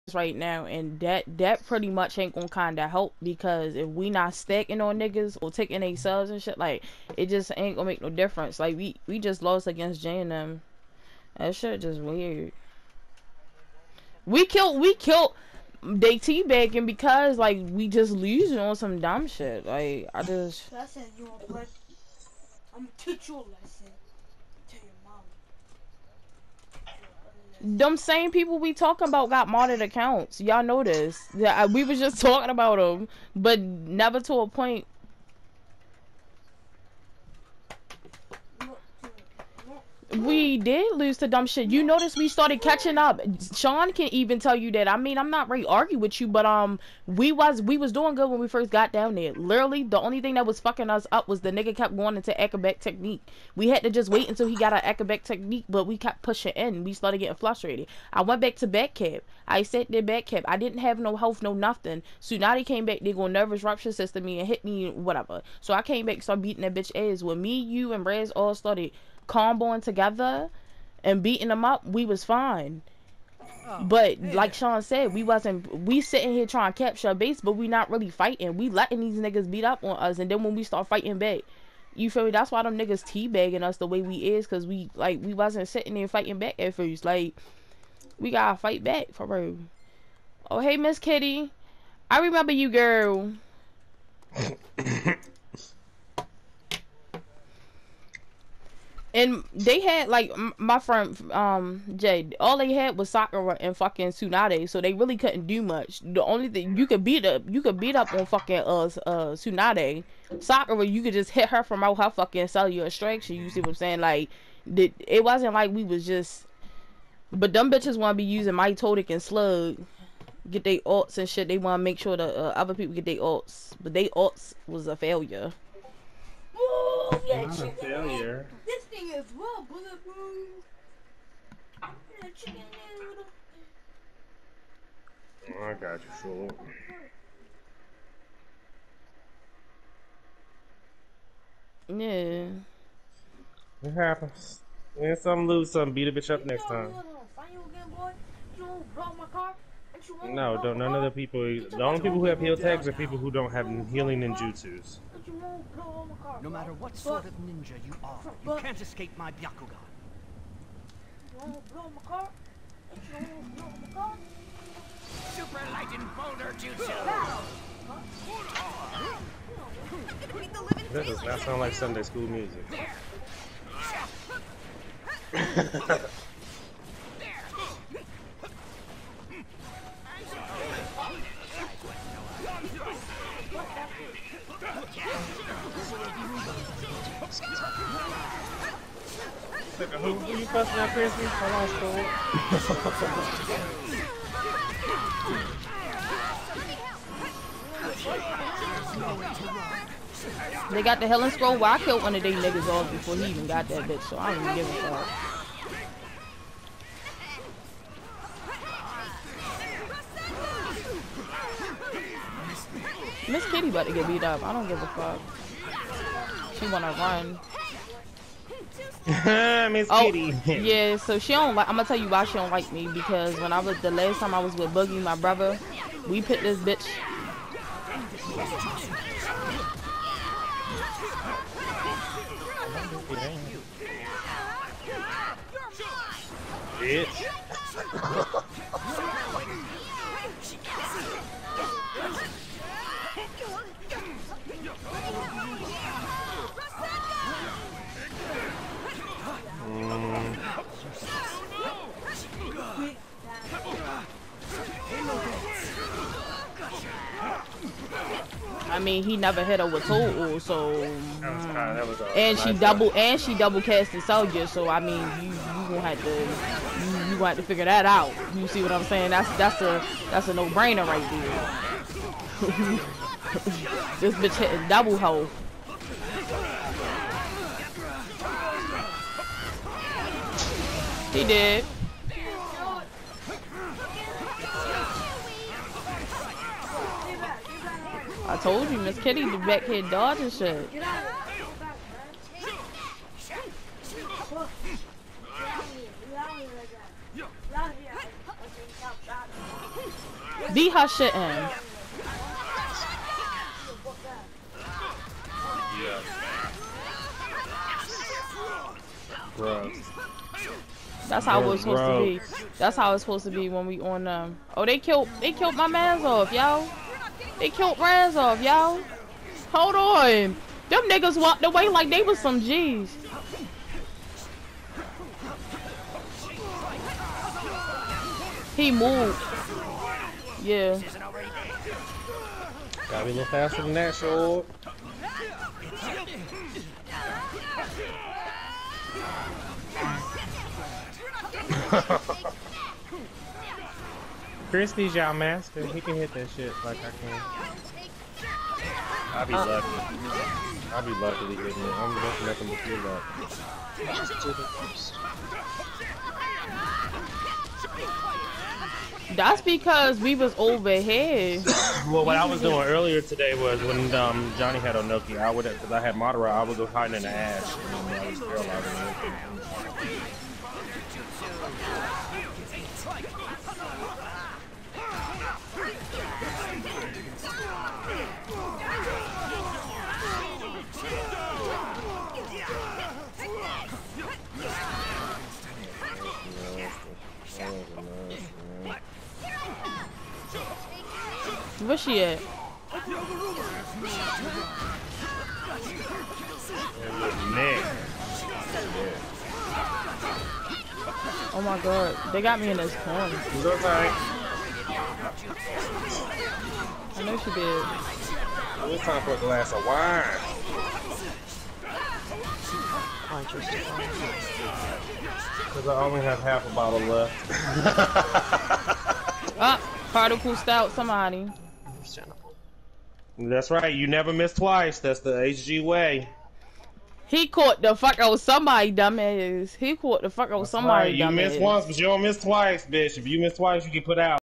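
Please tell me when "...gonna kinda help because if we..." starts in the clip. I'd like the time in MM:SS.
00:02.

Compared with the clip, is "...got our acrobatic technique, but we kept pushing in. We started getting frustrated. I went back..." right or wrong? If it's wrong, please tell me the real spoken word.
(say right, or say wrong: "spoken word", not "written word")
right.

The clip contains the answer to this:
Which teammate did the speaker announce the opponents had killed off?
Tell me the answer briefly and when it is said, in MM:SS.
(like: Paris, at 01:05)
Razov, at 05:17.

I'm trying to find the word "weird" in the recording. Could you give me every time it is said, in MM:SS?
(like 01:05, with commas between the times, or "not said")
00:11.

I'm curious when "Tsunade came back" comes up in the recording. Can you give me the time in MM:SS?
01:02.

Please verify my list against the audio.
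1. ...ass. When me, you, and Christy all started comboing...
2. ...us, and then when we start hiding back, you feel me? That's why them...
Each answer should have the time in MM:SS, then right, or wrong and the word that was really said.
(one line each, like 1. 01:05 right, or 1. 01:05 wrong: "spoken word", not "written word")
1. 01:06 wrong: "Raz", not "Christy"
2. 01:19 wrong: "fighting", not "hiding".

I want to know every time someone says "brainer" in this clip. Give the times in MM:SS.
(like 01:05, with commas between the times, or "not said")
04:30.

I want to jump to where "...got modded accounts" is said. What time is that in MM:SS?
00:29.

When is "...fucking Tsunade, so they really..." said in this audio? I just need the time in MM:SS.
01:43.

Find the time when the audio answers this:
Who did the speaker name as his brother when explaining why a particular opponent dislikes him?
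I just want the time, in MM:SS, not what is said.
03:44.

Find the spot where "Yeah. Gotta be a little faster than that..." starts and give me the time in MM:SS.
05:30.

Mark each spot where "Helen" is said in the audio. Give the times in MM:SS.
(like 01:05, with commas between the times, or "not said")
03:21.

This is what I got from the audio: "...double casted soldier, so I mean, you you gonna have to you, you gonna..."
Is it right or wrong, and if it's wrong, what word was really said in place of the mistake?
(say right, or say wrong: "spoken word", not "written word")
right.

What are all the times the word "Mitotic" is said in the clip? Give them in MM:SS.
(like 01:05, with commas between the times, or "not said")
01:58.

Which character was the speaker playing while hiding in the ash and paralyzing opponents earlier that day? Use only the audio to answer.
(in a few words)
Madara.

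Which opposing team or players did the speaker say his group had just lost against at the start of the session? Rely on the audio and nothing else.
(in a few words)
J and M.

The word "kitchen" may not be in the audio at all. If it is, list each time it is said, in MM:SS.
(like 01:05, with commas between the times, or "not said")
not said.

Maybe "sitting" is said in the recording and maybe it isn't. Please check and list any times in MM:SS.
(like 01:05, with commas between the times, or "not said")
01:16, 01:25.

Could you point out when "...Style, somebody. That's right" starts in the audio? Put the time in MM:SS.
07:00.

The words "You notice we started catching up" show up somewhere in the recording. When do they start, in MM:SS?
00:41.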